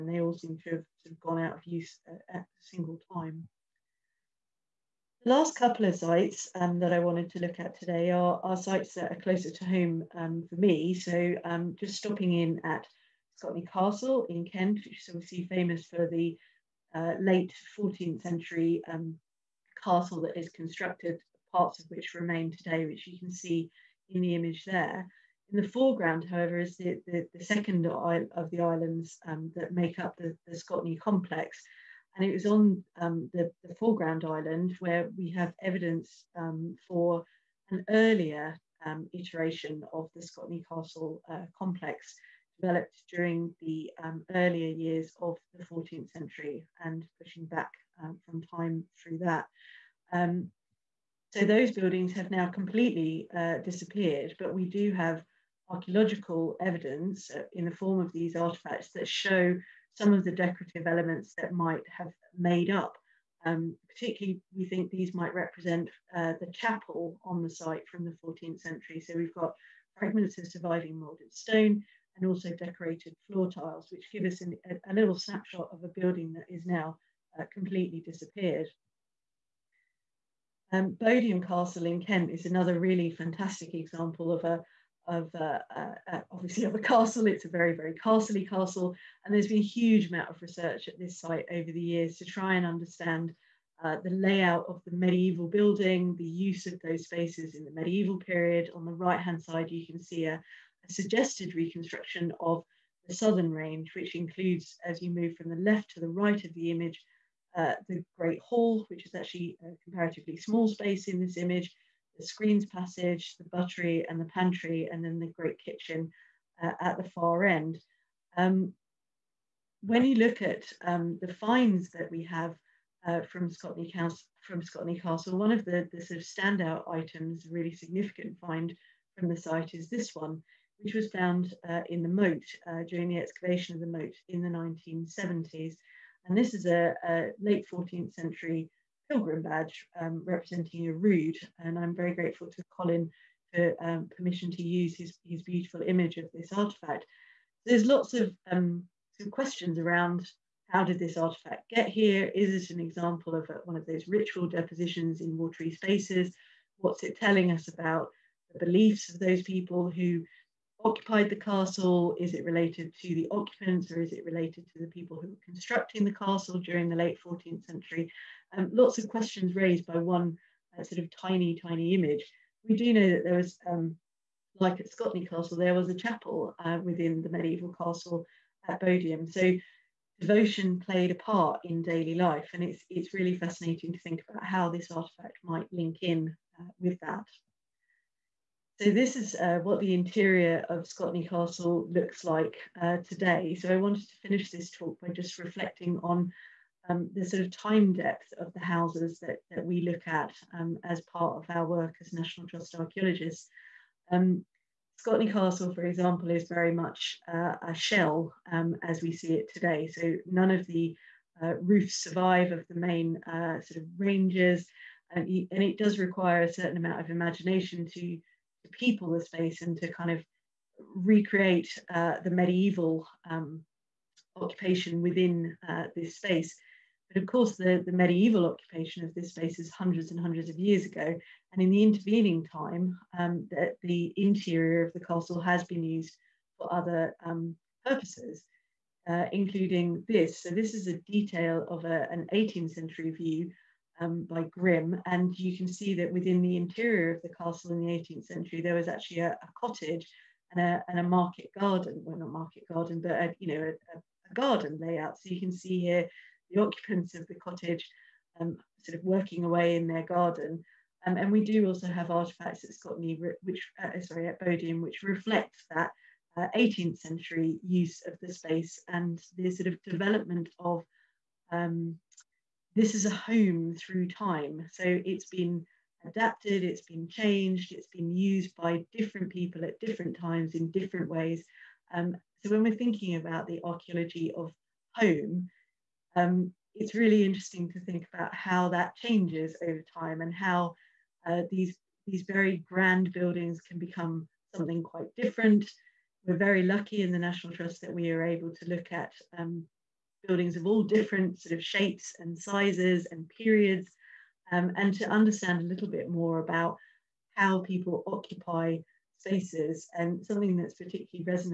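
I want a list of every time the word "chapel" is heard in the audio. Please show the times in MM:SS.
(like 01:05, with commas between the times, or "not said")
01:06, 02:55.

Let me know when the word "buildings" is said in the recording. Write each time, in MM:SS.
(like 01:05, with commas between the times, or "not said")
00:51, 01:15, 01:35, 04:53, 05:00.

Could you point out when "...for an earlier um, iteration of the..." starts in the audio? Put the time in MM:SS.
00:36.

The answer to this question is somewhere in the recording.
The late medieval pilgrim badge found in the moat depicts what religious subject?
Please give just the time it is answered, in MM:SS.
02:20.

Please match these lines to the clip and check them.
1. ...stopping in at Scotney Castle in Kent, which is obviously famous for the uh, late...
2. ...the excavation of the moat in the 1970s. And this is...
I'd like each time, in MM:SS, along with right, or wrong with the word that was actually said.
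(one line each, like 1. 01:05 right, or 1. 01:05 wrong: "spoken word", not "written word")
1. 00:11 right
2. 02:13 right.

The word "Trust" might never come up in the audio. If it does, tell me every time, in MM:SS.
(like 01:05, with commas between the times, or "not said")
03:22, 04:57.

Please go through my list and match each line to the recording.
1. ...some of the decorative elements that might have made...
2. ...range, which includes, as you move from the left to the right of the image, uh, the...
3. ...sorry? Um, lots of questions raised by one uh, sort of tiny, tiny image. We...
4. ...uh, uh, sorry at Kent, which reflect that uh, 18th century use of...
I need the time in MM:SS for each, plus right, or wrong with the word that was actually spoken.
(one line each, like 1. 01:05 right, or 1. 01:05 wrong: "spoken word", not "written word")
1. 00:59 right
2. 01:43 right
3. 02:47 wrong: "century", not "sorry"
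4. 04:23 wrong: "Bodiam", not "Kent".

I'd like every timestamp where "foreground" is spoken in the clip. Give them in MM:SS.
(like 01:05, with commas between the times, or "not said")
00:25, 00:33.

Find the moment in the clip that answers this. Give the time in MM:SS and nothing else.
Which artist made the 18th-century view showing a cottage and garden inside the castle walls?
04:04.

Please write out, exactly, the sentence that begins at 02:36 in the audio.
What's it telling us about the beliefs of those people who occupied the castle?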